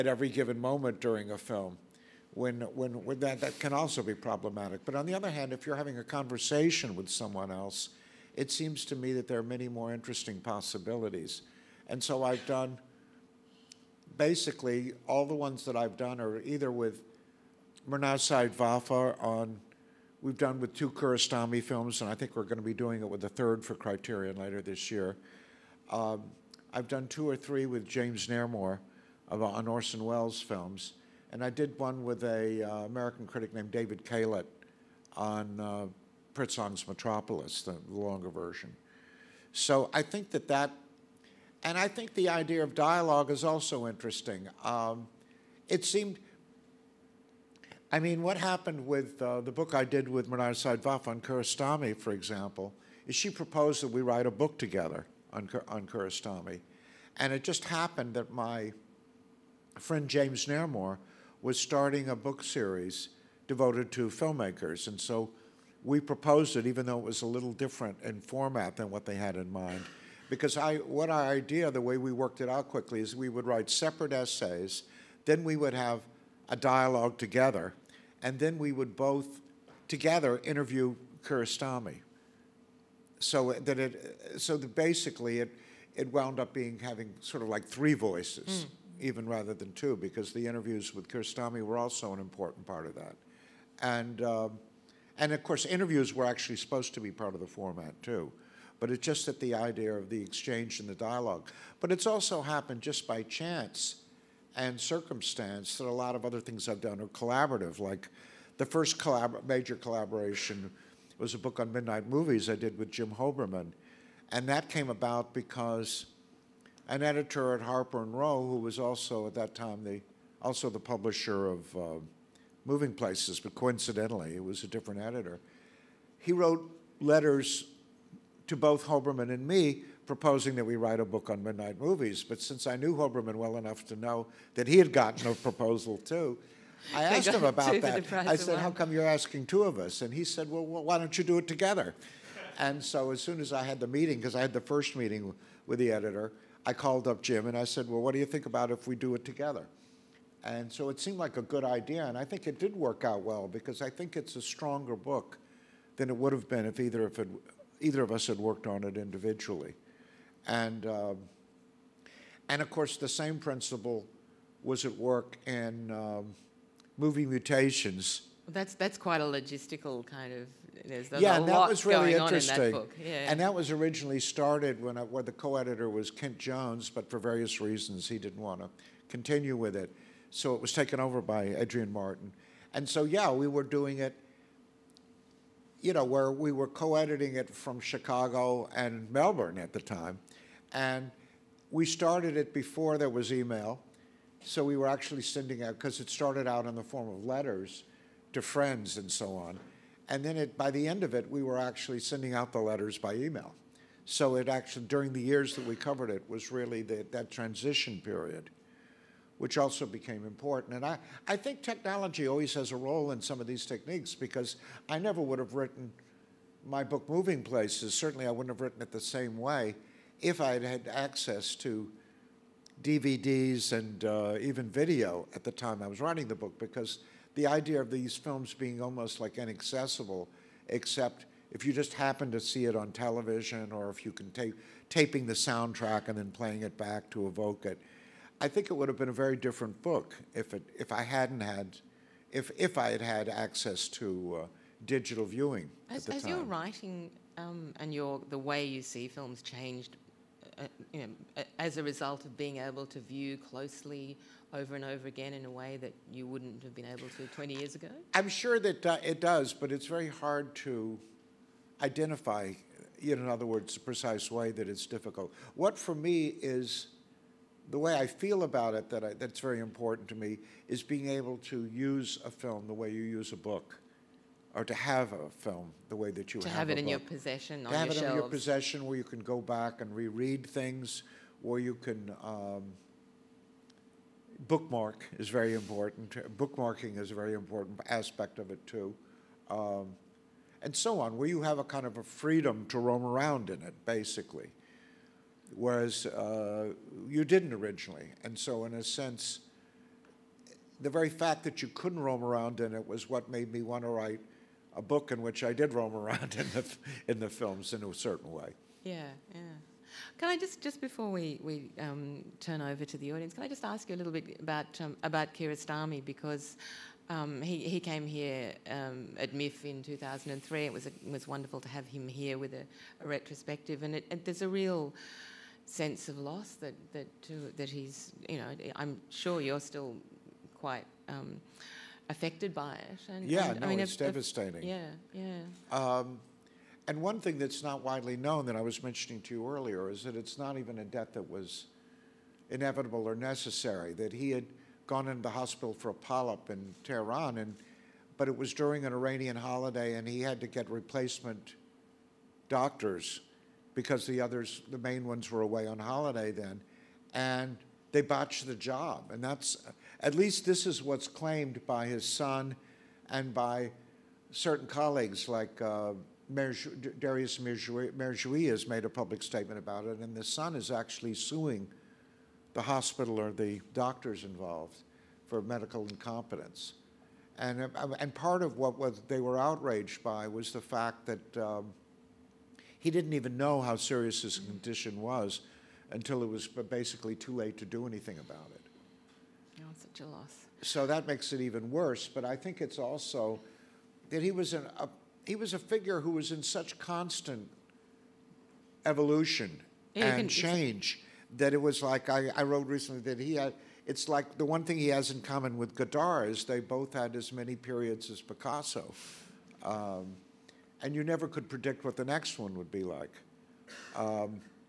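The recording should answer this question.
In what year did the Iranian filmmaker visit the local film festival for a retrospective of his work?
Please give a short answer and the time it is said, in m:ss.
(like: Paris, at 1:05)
2003, at 5:19.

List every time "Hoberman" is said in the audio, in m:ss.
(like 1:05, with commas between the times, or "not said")
1:53, 2:08, 2:12.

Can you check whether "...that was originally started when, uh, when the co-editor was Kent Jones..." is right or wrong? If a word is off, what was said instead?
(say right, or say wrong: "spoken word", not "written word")
right.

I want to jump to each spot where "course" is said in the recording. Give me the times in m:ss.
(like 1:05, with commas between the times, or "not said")
1:35, 2:42.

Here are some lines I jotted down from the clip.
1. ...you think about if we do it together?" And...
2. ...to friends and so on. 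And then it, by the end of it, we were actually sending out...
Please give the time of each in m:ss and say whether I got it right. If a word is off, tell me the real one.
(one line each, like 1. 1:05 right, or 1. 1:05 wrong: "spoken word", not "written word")
1. 2:28 right
2. 3:18 right.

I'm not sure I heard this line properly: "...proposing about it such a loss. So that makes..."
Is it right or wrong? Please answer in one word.
wrong.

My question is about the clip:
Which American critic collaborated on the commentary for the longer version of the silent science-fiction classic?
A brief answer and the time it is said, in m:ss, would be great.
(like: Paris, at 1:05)
David Kalat, at 0:33.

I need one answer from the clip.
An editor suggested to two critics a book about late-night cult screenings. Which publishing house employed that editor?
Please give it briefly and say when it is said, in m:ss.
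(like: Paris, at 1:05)
Harper and Row, at 1:57.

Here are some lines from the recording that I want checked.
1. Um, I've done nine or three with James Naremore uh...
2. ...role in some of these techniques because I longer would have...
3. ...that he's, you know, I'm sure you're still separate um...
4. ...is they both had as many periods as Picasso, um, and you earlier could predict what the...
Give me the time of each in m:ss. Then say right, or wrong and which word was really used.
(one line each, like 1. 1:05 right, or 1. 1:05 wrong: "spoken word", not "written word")
1. 0:25 wrong: "two", not "nine"
2. 3:32 wrong: "never", not "longer"
3. 5:27 wrong: "quite", not "separate"
4. 6:46 wrong: "never", not "earlier".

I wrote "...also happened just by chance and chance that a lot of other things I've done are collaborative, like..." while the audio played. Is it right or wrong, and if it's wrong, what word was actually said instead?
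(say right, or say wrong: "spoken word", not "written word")
wrong: "circumstance", not "chance".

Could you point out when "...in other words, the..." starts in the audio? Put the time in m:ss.
4:23.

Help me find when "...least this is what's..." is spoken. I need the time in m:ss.
6:00.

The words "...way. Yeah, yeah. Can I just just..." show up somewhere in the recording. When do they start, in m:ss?
5:08.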